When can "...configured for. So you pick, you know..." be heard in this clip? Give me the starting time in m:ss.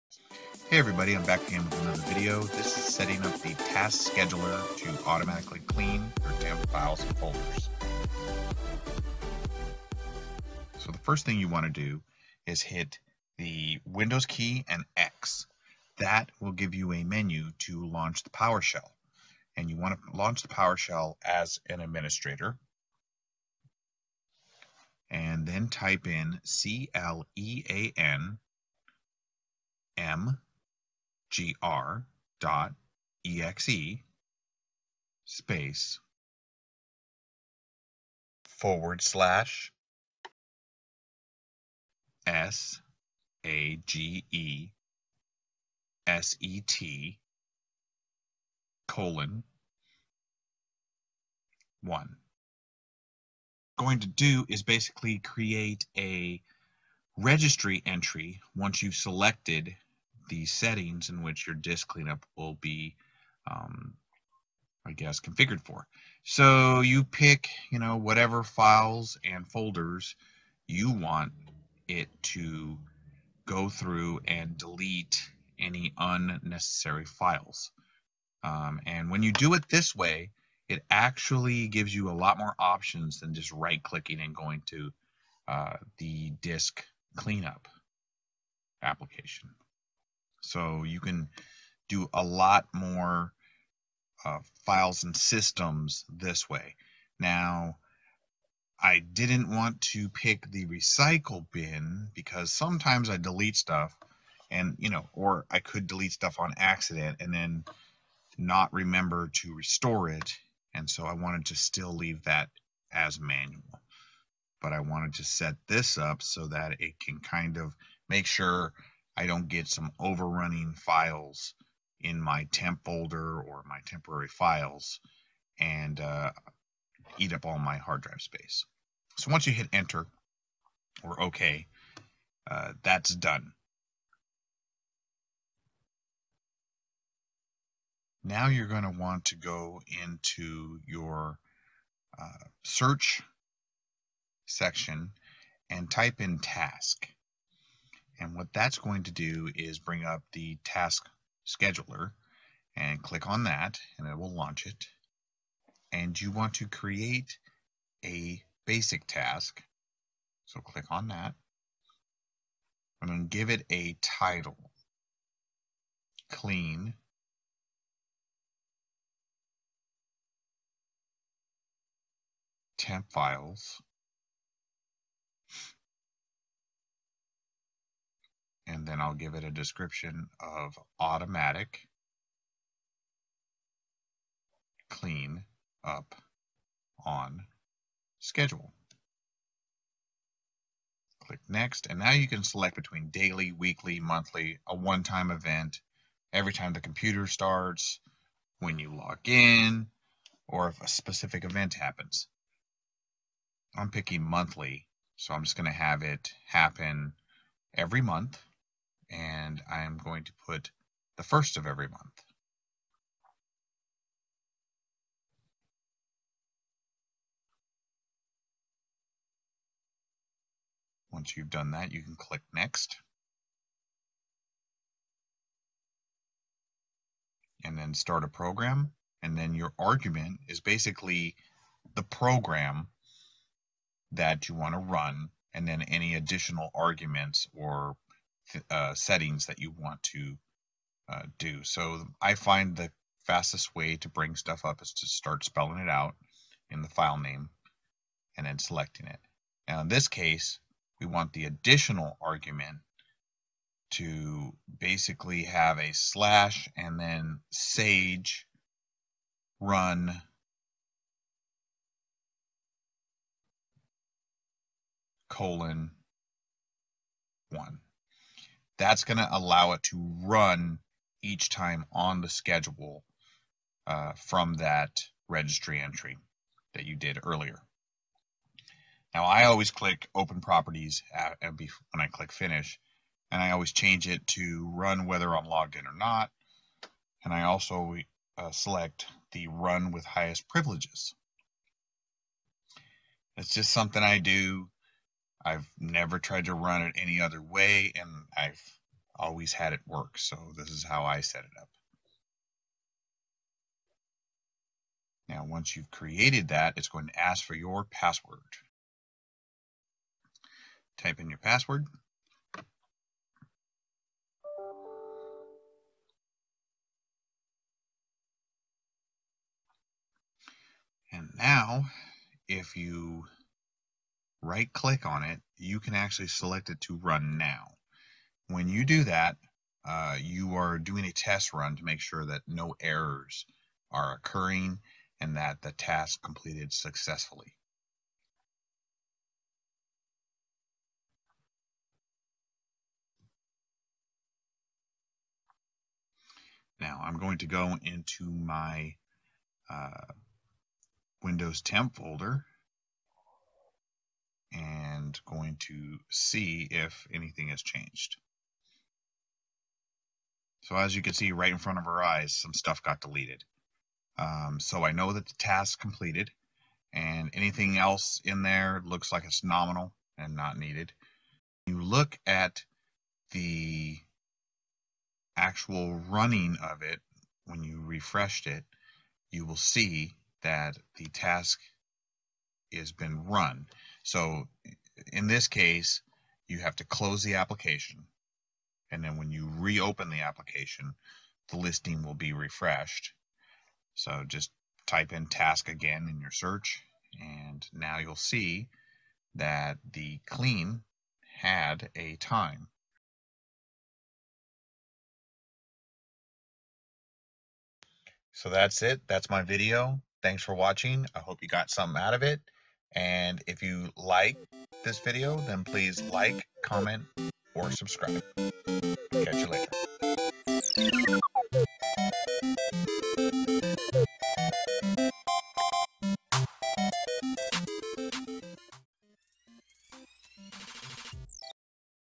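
1:05.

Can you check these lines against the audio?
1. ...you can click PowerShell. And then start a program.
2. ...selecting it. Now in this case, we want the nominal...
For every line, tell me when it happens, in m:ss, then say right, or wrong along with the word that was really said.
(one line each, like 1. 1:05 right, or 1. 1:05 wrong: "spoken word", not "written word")
1. 3:41 wrong: "Next", not "PowerShell"
2. 4:08 wrong: "additional", not "nominal".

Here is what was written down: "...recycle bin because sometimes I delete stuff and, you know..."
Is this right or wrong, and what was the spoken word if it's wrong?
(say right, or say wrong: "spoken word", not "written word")
right.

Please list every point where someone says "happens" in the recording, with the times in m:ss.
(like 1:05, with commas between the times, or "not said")
3:21, 3:26.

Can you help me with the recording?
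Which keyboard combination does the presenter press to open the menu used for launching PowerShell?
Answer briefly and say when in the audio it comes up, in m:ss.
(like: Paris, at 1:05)
Windows key and X, at 0:13.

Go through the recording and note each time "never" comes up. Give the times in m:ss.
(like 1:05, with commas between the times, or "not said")
4:55.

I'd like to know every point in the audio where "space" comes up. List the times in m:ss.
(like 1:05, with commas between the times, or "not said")
0:35, 2:08.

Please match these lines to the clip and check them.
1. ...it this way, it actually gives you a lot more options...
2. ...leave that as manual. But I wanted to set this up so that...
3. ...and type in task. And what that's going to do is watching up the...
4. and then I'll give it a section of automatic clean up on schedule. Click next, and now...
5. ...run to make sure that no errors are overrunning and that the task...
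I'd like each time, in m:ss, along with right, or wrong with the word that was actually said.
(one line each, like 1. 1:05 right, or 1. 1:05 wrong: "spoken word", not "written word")
1. 1:19 right
2. 1:51 right
3. 2:25 wrong: "bring", not "watching"
4. 2:58 wrong: "description", not "section"
5. 5:31 wrong: "occurring", not "overrunning".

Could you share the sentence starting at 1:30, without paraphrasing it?
So you can do a lot more uh, files and systems this way.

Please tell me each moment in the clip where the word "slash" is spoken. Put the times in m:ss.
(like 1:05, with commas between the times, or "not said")
0:39, 4:15.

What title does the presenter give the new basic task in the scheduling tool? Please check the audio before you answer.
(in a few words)
Clean Temp files.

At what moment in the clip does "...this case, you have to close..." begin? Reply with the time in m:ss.
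6:25.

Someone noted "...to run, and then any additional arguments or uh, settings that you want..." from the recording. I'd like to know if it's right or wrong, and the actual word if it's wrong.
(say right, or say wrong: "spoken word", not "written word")
right.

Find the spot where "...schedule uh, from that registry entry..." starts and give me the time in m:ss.
4:32.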